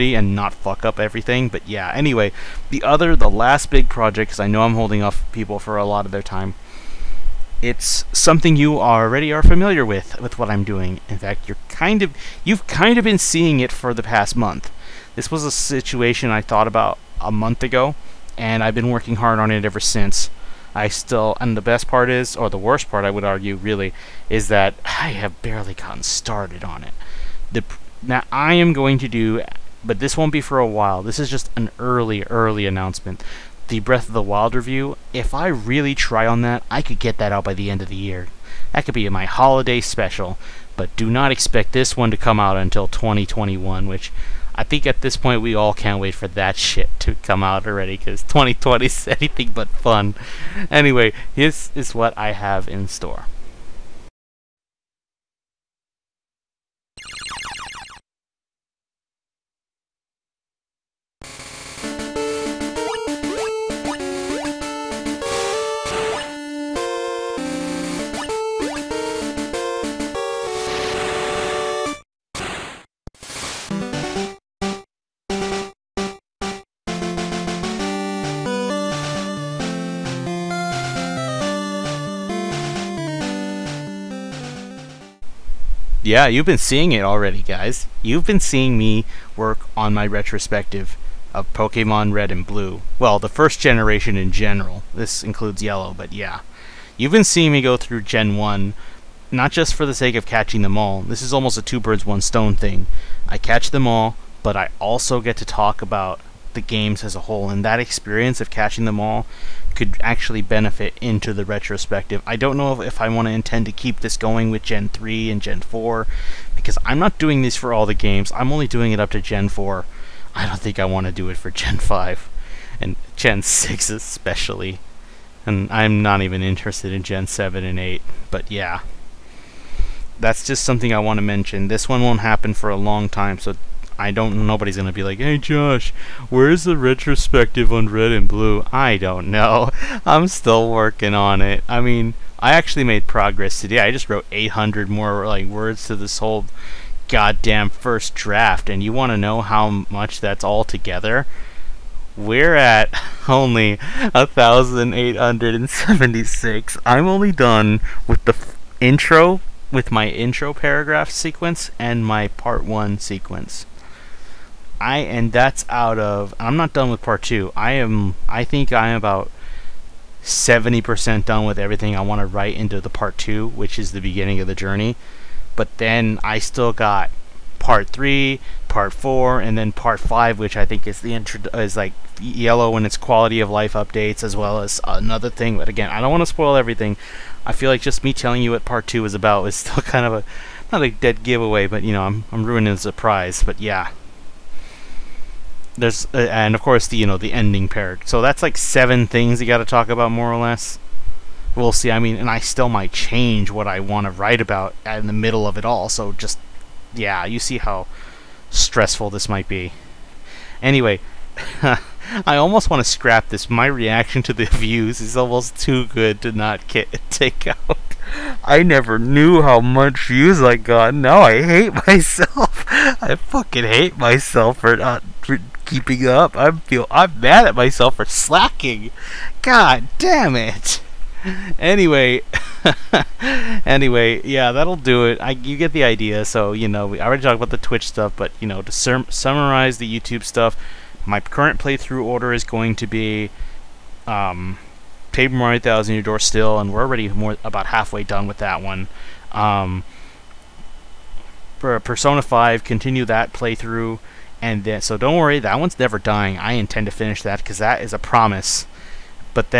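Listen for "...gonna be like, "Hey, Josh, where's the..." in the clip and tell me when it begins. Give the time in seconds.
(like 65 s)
134 s.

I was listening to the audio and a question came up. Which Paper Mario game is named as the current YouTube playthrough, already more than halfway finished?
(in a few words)
1000 Year Door.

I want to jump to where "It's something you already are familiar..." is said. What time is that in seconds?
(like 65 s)
7 s.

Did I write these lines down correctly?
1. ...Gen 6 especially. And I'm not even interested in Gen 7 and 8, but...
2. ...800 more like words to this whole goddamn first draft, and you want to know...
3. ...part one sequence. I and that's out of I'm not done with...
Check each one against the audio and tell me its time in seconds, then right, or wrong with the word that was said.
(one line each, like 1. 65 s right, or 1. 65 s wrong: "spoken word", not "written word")
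1. 123 s right
2. 144 s right
3. 162 s right.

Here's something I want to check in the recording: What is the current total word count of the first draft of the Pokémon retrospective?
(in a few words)
1,876.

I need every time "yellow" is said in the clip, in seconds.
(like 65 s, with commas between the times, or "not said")
95 s, 182 s.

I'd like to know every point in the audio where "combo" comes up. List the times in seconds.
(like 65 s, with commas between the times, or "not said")
not said.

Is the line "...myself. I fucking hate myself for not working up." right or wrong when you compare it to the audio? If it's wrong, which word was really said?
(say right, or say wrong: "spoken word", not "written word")
wrong: "keeping", not "working".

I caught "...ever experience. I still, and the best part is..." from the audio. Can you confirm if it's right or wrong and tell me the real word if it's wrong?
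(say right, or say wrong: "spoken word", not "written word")
wrong: "since", not "experience".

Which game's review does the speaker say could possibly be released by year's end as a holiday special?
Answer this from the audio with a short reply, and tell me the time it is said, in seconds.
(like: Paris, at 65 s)
Breath of the Wild, at 33 s.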